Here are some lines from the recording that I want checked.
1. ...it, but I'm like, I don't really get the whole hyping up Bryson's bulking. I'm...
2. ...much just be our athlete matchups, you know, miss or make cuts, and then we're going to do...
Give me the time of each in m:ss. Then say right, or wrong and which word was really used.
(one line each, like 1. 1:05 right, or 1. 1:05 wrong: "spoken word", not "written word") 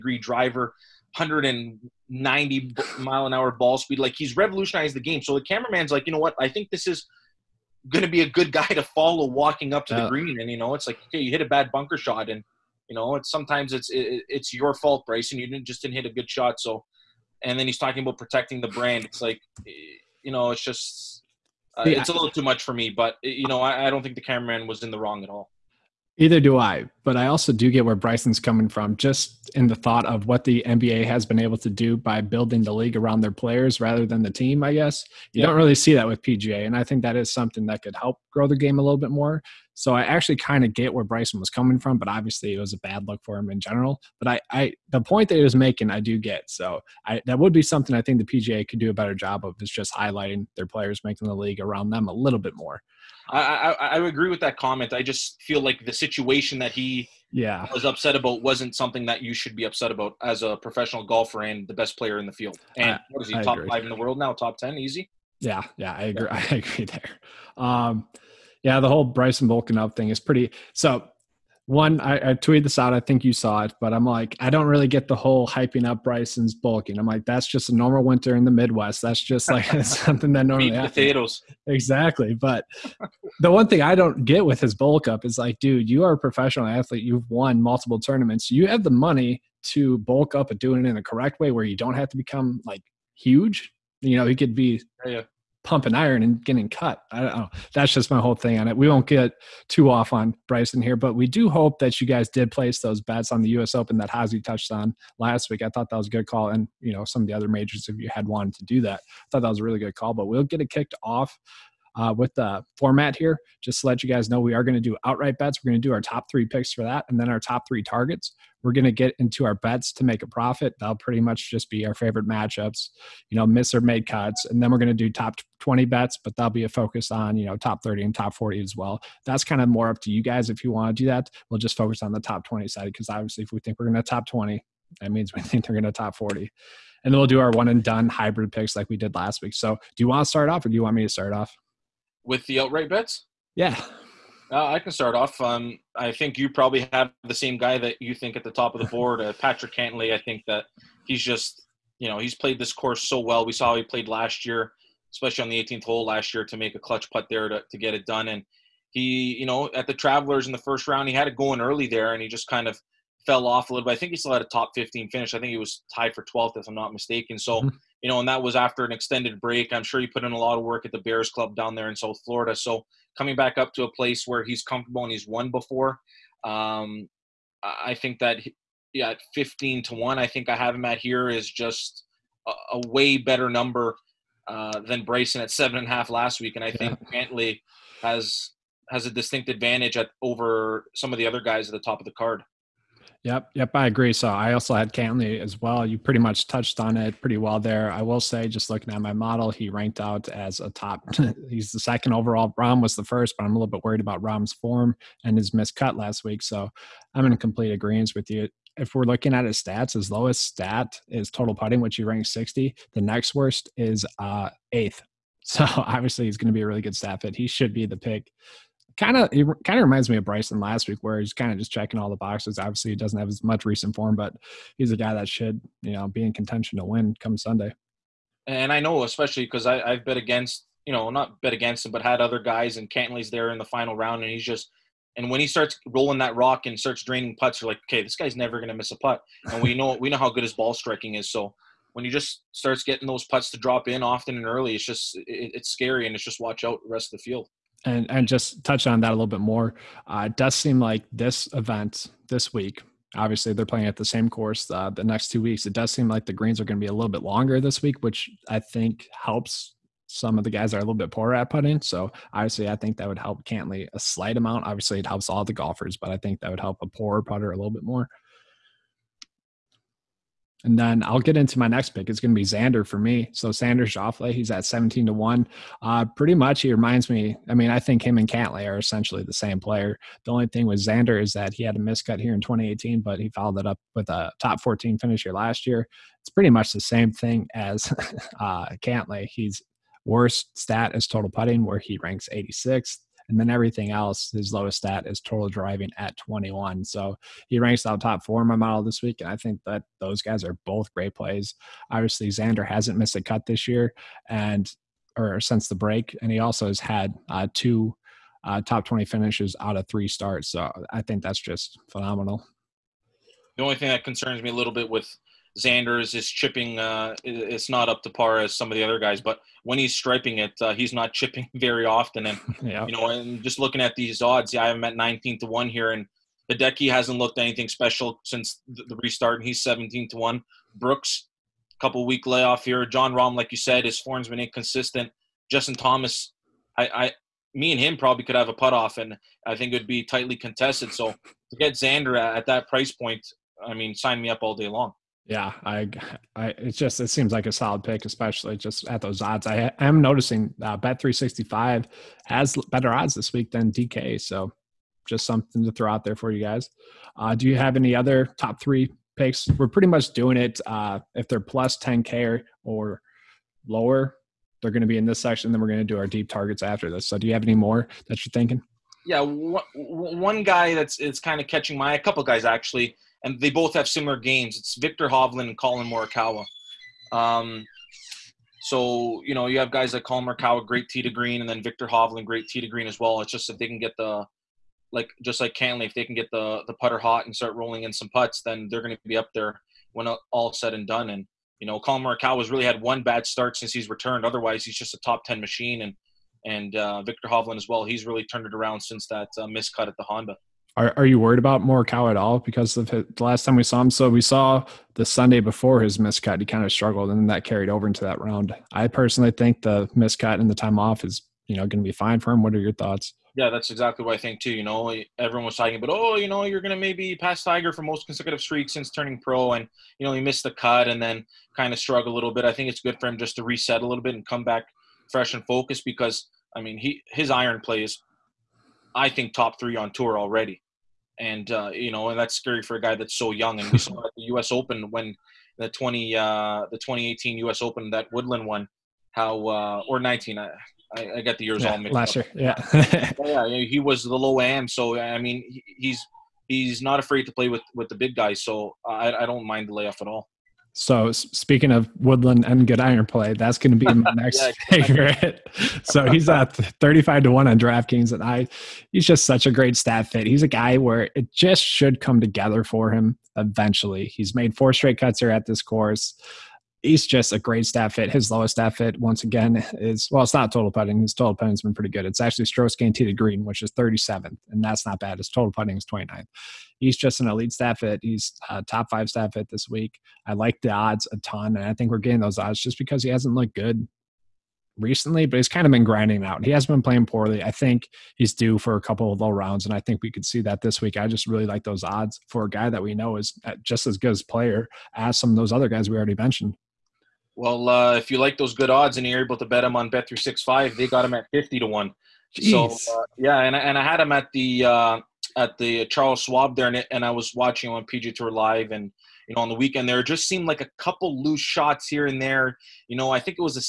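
1. 1:13 right
2. 2:01 wrong: "favorite", not "athlete".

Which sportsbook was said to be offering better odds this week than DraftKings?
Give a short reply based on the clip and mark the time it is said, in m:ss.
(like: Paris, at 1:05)
Bet365, at 5:50.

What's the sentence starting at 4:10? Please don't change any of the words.
Uh, it does seem like this event this week.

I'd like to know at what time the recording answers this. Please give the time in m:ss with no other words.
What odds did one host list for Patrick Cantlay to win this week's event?
2:59.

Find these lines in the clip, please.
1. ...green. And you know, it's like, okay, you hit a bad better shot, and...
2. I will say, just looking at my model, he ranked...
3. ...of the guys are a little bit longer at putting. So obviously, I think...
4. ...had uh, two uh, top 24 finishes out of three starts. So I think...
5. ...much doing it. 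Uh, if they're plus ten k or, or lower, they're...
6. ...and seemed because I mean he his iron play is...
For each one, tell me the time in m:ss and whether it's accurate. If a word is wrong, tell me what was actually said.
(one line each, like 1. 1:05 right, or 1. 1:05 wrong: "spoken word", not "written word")
1. 0:10 wrong: "bunker", not "better"
2. 3:17 right
3. 4:20 wrong: "poorer", not "longer"
4. 5:06 wrong: "20", not "24"
5. 5:59 right
6. 7:05 wrong: "focused", not "seemed".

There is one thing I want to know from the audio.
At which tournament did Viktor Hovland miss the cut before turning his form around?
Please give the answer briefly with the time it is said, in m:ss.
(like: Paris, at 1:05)
Honda, at 6:40.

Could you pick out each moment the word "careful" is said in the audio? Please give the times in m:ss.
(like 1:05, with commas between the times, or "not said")
not said.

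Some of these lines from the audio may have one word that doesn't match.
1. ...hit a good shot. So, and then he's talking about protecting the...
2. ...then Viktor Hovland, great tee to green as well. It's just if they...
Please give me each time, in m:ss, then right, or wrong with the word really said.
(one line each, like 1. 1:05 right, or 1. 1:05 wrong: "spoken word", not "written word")
1. 0:15 right
2. 6:21 right.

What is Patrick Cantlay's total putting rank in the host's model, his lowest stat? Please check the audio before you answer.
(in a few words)
60.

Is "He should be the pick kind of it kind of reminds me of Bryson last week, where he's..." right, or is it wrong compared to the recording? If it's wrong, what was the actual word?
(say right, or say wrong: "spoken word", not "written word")
right.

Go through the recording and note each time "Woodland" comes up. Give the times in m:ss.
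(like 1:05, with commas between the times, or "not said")
7:18, 7:31.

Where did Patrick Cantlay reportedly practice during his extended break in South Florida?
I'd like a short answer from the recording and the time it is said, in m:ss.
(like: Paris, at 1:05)
Bears Club, at 2:50.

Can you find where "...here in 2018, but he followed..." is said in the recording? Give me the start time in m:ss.
4:42.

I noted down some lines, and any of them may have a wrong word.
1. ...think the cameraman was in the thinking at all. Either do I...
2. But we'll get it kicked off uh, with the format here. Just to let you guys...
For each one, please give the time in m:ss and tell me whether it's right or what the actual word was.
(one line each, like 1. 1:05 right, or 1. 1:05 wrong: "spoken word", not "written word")
1. 0:24 wrong: "wrong", not "thinking"
2. 1:50 right.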